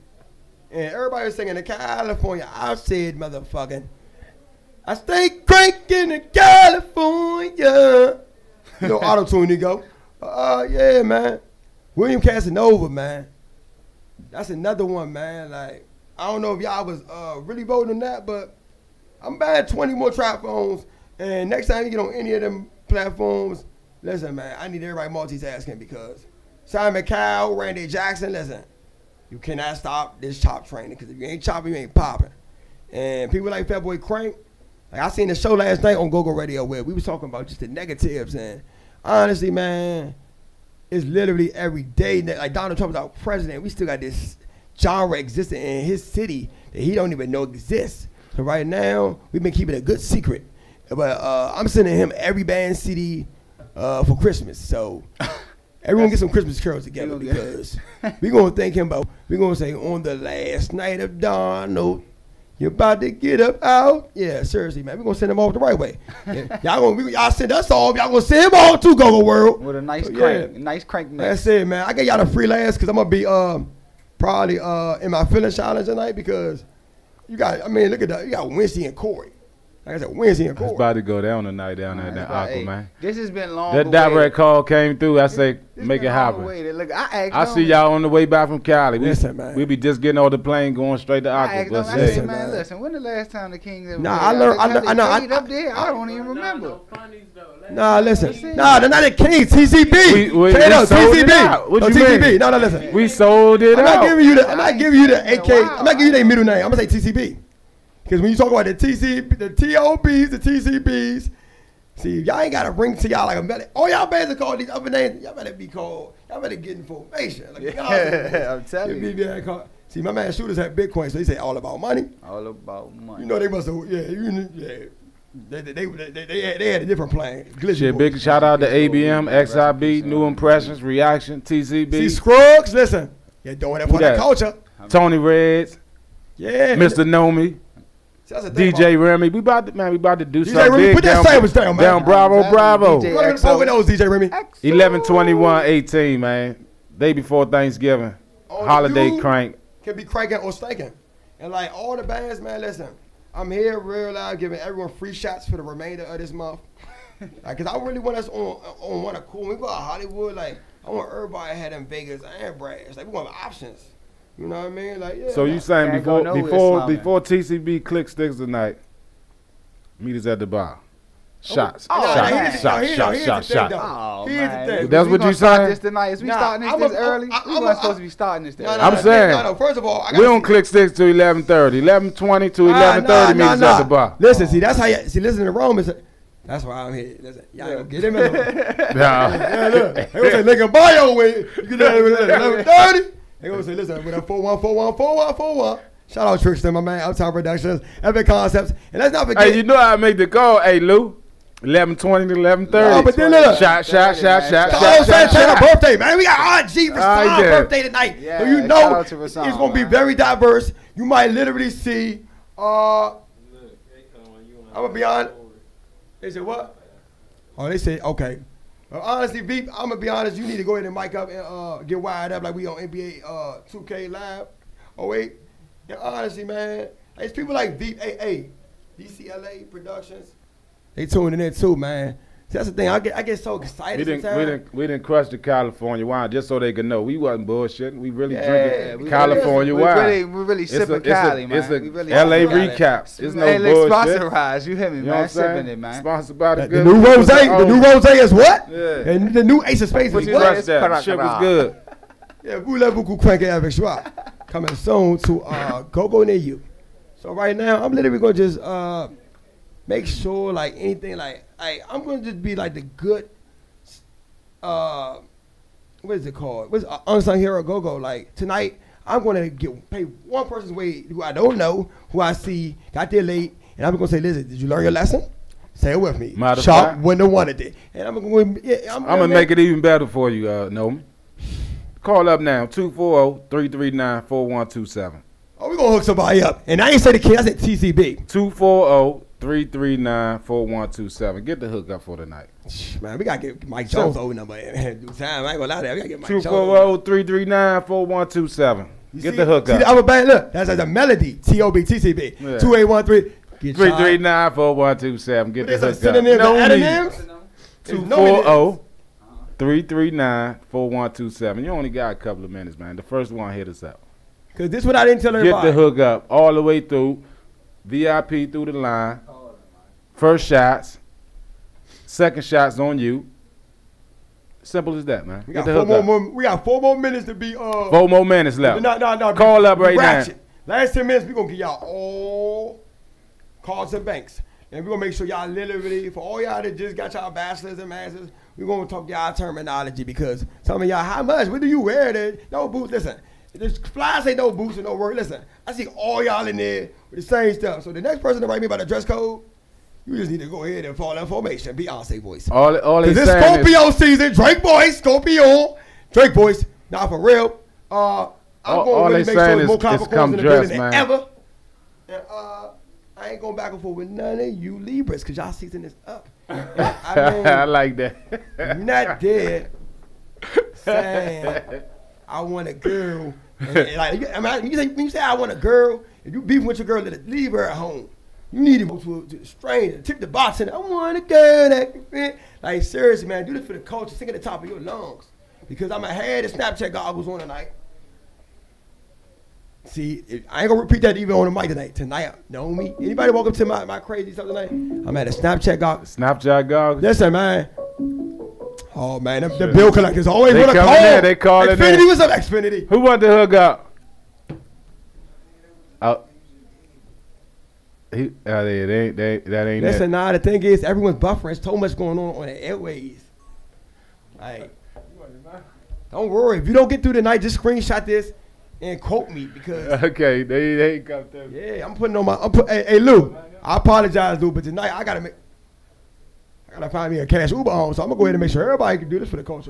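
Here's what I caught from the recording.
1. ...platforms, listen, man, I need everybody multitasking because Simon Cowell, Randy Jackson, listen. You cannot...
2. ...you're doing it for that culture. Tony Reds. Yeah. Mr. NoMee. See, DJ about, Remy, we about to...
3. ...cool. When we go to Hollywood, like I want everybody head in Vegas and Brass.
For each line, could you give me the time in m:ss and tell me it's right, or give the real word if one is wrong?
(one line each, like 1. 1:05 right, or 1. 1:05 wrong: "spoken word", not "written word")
1. 0:22 right
2. 2:13 right
3. 2:39 right.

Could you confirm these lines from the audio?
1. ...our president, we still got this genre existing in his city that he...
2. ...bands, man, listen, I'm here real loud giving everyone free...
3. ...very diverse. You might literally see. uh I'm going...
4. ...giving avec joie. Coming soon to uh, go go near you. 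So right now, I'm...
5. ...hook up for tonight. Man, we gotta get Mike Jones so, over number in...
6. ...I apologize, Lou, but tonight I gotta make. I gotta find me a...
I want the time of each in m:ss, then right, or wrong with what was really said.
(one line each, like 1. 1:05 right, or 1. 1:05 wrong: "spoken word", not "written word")
1. 0:42 right
2. 2:32 right
3. 3:29 right
4. 4:13 wrong: "cranking", not "giving"
5. 4:51 right
6. 7:03 right.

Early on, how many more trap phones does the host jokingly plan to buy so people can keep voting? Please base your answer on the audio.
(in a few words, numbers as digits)
20.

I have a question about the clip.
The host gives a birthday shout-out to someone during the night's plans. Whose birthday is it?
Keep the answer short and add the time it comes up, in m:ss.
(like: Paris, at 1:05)
Santana, at 3:25.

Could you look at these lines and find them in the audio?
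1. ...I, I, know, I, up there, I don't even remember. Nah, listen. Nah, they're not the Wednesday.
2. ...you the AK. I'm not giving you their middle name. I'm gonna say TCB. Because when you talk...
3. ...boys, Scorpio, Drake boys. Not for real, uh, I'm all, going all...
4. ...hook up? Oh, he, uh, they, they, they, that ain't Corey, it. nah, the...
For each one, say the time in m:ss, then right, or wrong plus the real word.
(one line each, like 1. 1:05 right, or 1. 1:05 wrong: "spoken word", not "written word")
1. 1:34 wrong: "Kings", not "Wednesday"
2. 1:44 right
3. 5:54 right
4. 6:43 wrong: "Listen", not "Corey".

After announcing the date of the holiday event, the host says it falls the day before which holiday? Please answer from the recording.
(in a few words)
Thanksgiving.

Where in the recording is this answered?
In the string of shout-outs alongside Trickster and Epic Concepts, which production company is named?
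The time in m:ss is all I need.
3:17.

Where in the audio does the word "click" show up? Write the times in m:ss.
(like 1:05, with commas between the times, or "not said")
2:47, 3:00.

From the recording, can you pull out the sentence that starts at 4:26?
What's uh, unsung hero go go?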